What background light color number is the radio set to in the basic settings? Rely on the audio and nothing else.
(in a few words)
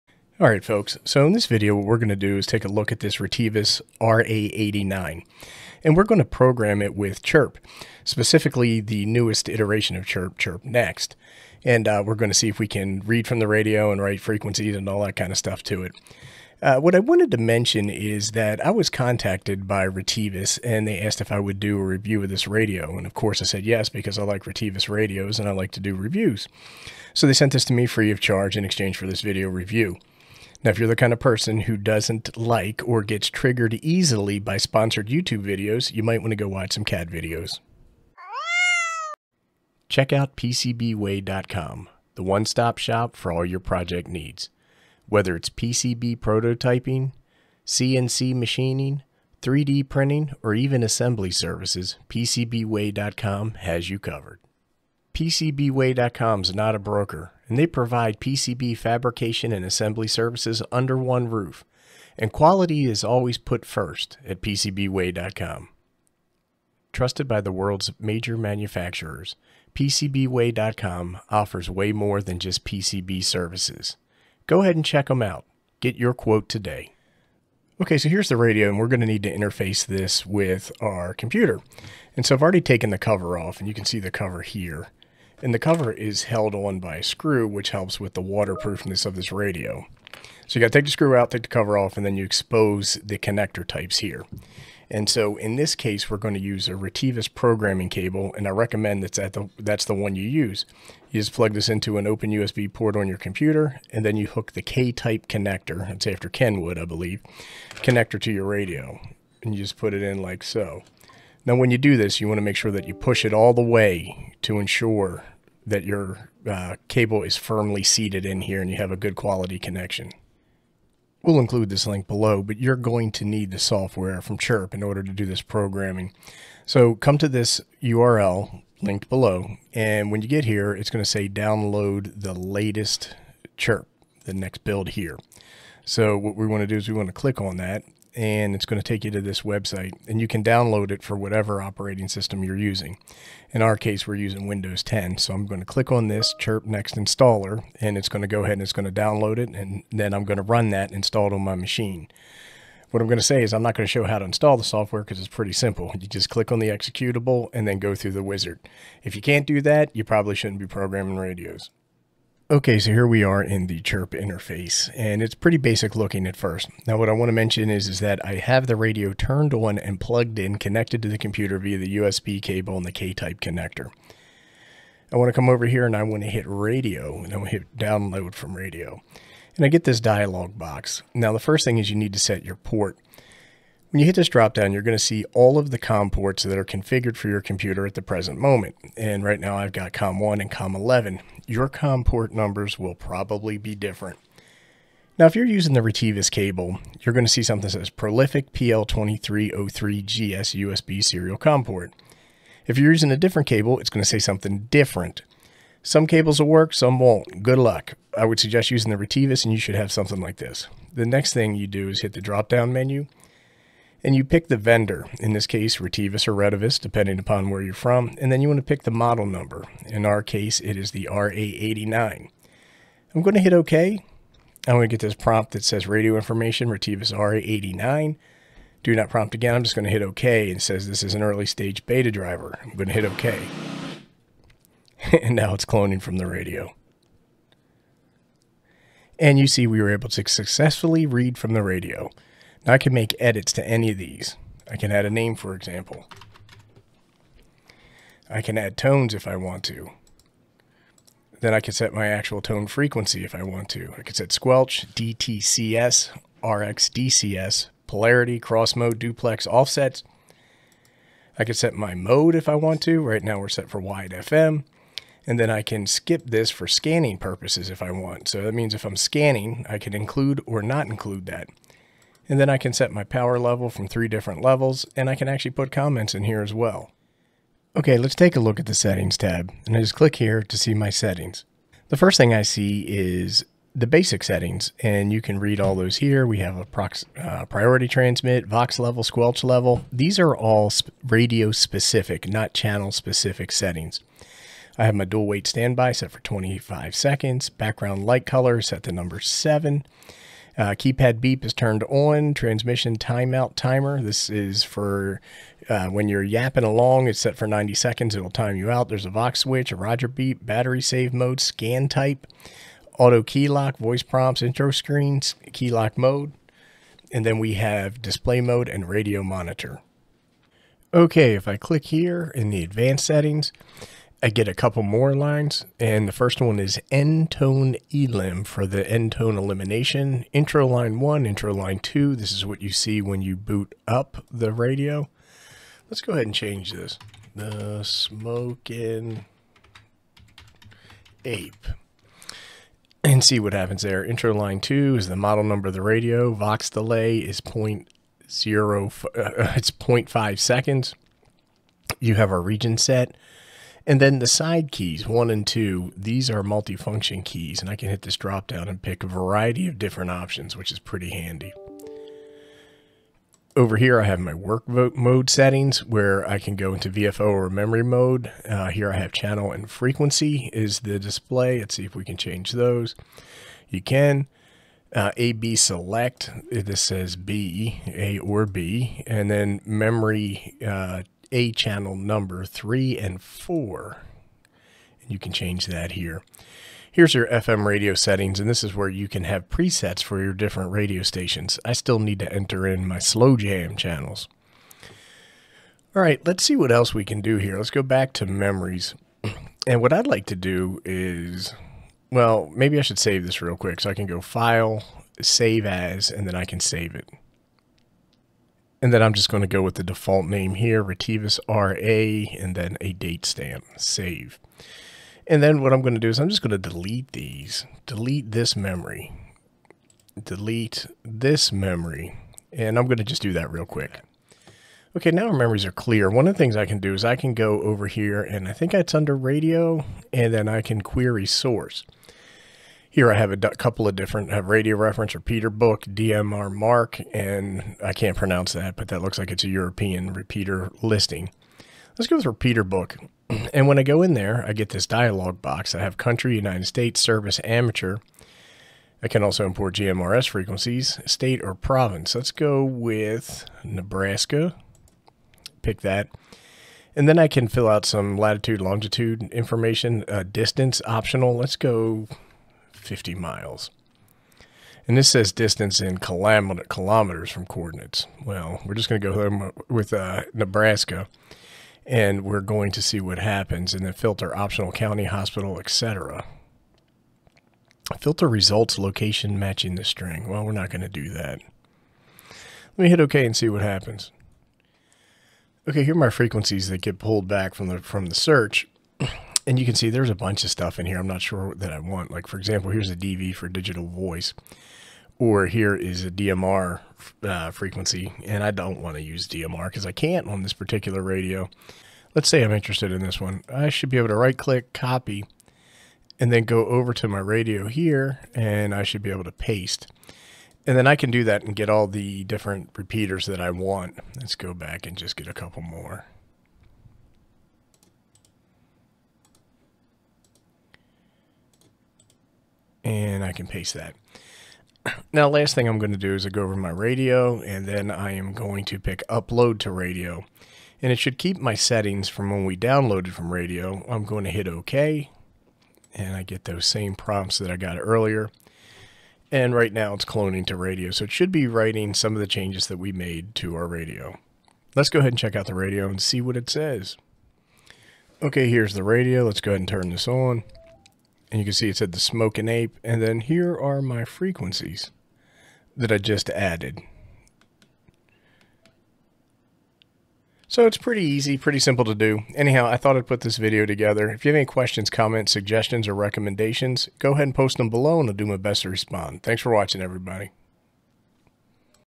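7.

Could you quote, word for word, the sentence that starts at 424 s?
Okay, now our memories are clear.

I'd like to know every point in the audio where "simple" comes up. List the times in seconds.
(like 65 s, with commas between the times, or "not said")
155 s, 561 s.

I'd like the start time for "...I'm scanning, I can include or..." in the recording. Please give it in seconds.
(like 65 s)
268 s.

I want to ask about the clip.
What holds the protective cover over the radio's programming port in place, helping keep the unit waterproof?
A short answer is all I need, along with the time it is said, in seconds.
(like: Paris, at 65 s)
A screw, at 86 s.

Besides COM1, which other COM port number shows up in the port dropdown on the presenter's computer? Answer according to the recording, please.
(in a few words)
COM11.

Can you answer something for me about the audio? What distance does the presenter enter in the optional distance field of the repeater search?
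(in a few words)
50 miles.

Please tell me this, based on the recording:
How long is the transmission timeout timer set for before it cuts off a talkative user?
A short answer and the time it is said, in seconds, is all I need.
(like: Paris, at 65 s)
90 seconds, at 307 s.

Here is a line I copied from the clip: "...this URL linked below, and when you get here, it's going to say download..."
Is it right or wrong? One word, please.
right.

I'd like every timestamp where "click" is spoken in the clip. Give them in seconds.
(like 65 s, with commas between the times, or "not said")
137 s, 145 s, 156 s, 279 s, 321 s, 504 s.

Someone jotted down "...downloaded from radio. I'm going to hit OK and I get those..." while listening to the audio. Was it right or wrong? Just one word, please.
right.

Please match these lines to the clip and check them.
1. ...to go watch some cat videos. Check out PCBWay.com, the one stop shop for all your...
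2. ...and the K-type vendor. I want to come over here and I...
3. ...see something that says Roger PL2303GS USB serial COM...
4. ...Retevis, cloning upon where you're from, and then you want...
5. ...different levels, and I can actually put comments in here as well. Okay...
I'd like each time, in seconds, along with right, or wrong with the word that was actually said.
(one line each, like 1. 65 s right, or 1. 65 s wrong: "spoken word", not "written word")
1. 36 s right
2. 172 s wrong: "connector", not "vendor"
3. 197 s wrong: "Prolific", not "Roger"
4. 216 s wrong: "depending", not "cloning"
5. 274 s right.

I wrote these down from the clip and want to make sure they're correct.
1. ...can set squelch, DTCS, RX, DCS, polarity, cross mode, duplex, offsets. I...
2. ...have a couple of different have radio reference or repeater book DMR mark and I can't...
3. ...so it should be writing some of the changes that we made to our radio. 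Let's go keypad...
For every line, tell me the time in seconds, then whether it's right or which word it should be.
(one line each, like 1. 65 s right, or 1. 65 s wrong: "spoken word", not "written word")
1. 254 s right
2. 433 s right
3. 540 s wrong: "ahead", not "keypad".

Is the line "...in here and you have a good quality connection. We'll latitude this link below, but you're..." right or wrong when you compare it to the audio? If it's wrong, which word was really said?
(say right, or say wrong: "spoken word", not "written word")
wrong: "include", not "latitude".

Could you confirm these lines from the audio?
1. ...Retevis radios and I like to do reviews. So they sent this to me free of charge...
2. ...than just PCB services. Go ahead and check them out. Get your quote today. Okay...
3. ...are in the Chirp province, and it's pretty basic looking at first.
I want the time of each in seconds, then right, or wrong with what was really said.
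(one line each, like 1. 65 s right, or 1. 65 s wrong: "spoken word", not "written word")
1. 24 s right
2. 72 s right
3. 163 s wrong: "interface", not "province".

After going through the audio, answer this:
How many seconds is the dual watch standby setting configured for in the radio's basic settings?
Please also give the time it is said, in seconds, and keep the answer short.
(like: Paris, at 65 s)
25, at 296 s.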